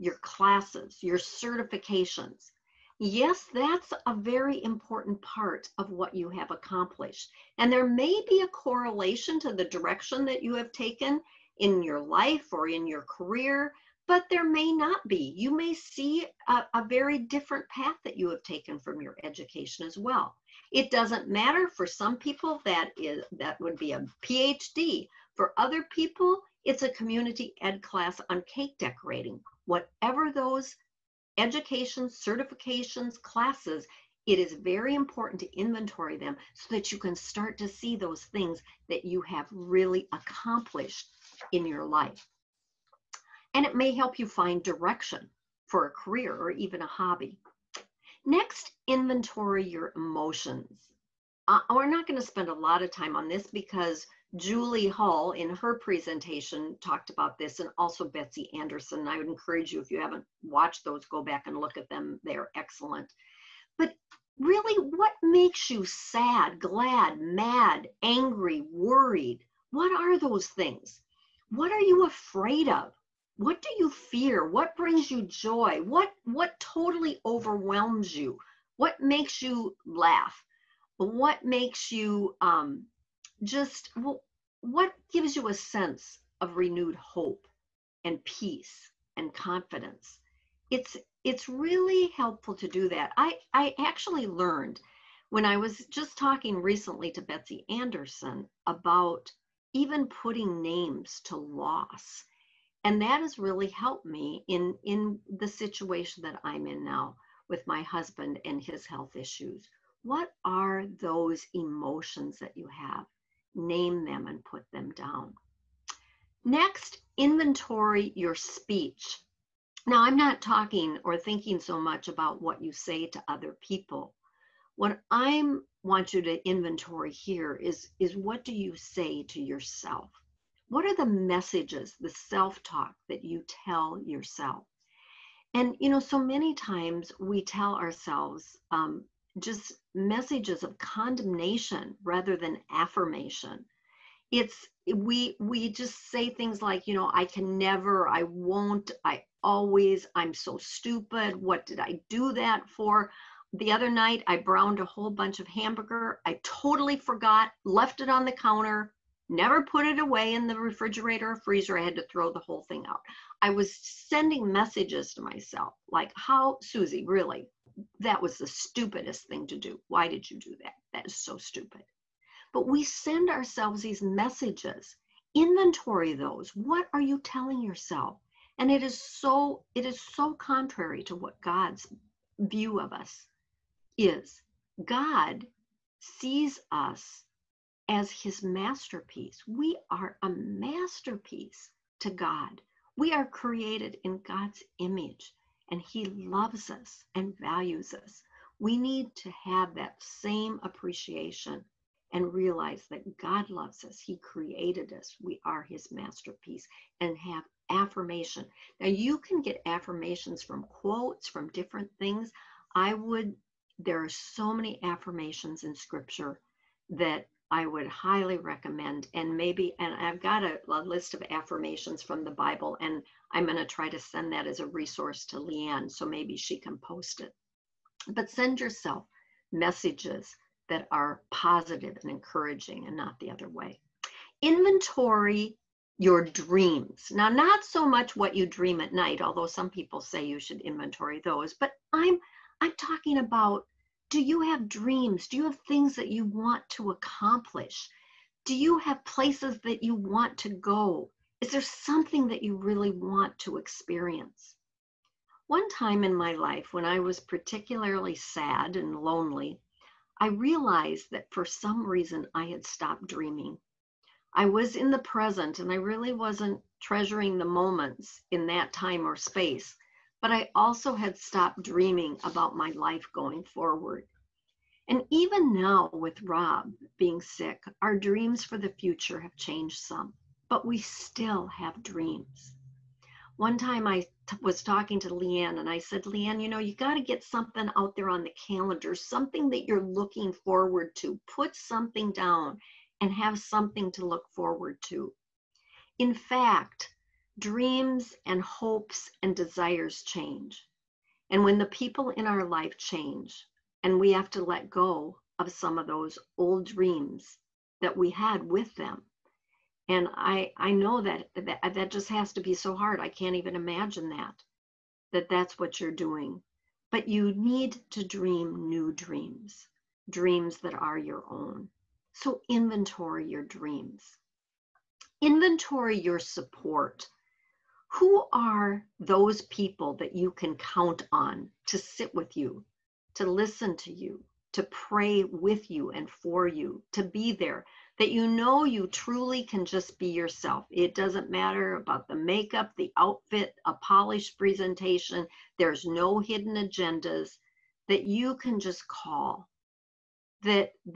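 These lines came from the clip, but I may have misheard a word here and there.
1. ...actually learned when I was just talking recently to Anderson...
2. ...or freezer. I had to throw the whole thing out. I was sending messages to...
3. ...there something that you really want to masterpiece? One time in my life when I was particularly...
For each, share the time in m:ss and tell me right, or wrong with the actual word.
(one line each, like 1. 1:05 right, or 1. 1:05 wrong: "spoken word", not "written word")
1. 1:33 wrong: "Betsy", not "Anderson"
2. 2:41 right
3. 4:11 wrong: "experience", not "masterpiece".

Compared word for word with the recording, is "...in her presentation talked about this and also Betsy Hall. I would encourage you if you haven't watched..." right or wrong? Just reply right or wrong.
wrong.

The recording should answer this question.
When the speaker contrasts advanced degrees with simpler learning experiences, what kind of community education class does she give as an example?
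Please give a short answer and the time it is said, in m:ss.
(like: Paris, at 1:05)
Cake decorating, at 0:28.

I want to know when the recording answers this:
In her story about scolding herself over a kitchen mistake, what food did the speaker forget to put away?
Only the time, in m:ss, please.
2:35.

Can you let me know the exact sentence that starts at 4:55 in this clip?
In fact, dreams and hopes and desires change.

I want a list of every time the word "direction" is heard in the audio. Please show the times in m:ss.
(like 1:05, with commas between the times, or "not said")
0:09, 0:44.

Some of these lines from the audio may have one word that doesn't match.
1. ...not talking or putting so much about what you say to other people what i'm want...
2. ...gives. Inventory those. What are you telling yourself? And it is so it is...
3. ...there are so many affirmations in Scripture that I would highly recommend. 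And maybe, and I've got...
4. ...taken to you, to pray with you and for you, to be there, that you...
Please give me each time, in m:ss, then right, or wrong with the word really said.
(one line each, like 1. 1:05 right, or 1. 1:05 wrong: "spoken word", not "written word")
1. 2:00 wrong: "thinking", not "putting"
2. 2:54 wrong: "messages", not "gives"
3. 3:33 right
4. 5:33 wrong: "listen", not "taken".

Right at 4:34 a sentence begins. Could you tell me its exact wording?
And even now, with Rob being sick, our dreams for the future have changed some, but we still have dreams.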